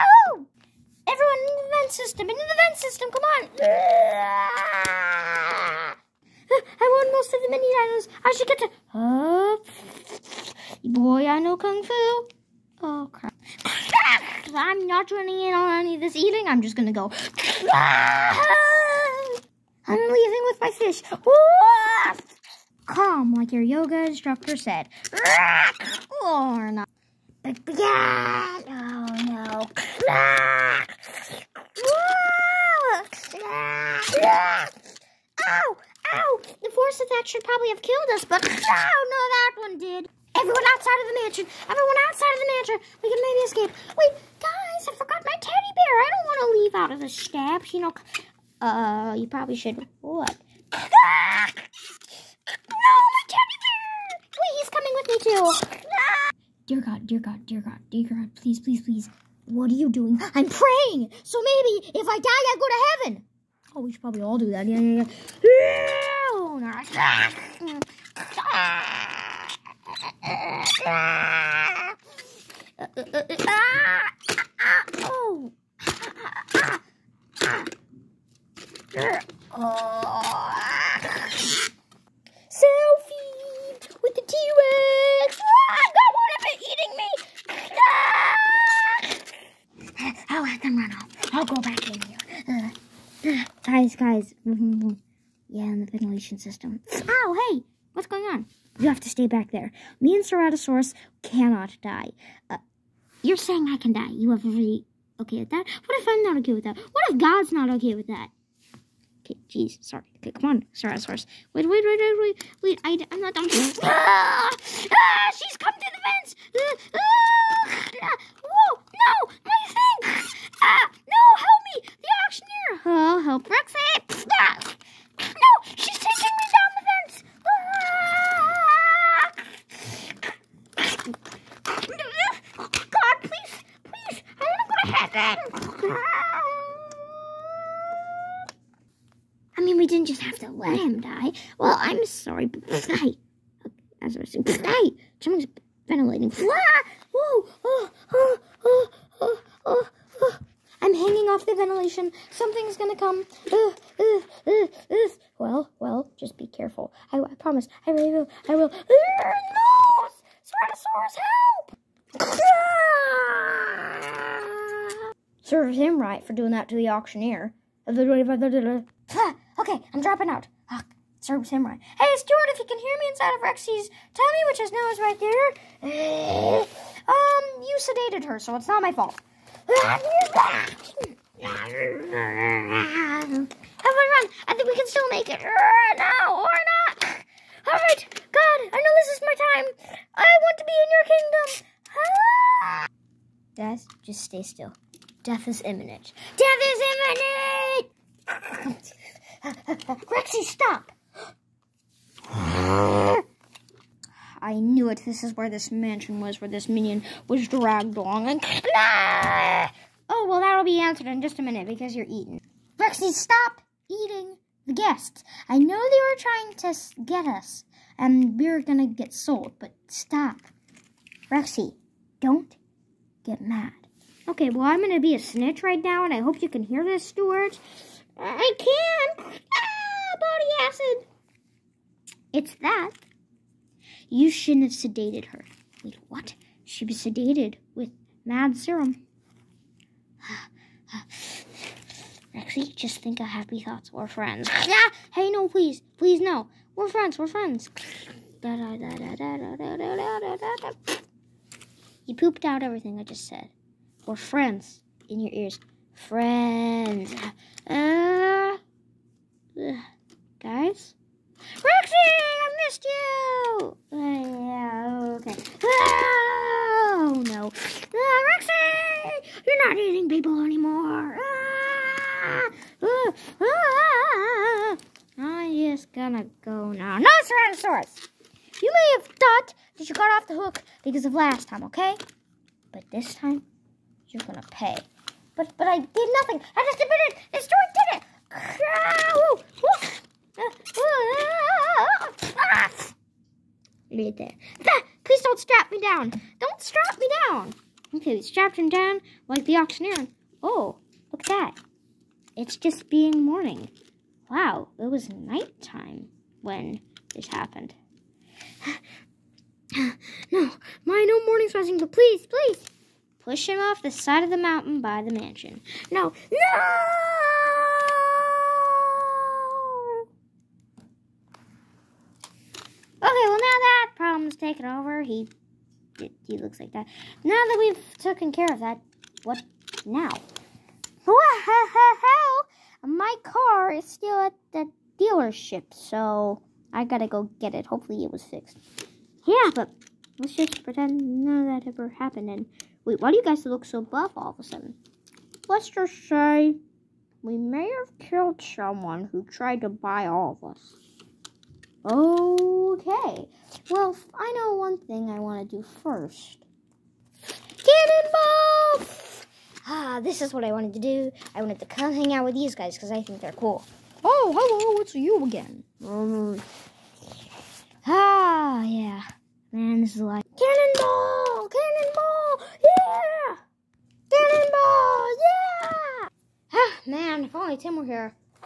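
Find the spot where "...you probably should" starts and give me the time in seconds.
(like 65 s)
49 s.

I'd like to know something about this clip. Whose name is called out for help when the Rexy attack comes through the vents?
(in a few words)
Roxanne.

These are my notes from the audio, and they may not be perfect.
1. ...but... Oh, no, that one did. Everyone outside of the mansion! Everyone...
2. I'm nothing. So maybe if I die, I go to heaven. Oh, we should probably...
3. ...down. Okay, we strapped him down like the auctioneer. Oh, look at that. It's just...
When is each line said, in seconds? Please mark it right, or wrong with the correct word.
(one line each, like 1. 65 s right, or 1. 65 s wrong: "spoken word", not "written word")
1. 38 s right
2. 60 s wrong: "praying", not "nothing"
3. 297 s right.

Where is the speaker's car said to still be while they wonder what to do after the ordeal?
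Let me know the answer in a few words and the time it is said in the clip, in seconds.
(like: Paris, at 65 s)
The dealership, at 334 s.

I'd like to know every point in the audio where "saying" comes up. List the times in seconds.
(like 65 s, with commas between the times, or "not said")
103 s, 144 s.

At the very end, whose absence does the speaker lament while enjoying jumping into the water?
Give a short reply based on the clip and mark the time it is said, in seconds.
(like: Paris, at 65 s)
Tim, at 377 s.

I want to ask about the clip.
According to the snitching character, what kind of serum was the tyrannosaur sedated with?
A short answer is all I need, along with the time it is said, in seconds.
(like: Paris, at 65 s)
Mad serum, at 238 s.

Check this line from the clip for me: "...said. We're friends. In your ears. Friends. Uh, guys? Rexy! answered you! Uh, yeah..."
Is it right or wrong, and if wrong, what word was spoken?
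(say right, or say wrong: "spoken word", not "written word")
wrong: "missed", not "answered".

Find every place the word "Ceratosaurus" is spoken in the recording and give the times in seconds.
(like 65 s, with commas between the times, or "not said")
100 s, 110 s, 160 s.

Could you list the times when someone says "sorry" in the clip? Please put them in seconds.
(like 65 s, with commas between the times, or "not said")
109 s, 142 s.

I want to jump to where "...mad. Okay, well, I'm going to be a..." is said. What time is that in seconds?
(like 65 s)
223 s.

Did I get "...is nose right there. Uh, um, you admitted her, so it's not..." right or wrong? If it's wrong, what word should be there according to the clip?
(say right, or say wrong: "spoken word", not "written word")
wrong: "sedated", not "admitted".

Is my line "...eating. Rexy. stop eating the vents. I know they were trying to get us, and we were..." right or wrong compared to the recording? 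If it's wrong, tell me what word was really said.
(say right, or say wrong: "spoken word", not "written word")
wrong: "guests", not "vents".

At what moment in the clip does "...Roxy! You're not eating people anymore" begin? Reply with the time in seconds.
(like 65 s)
268 s.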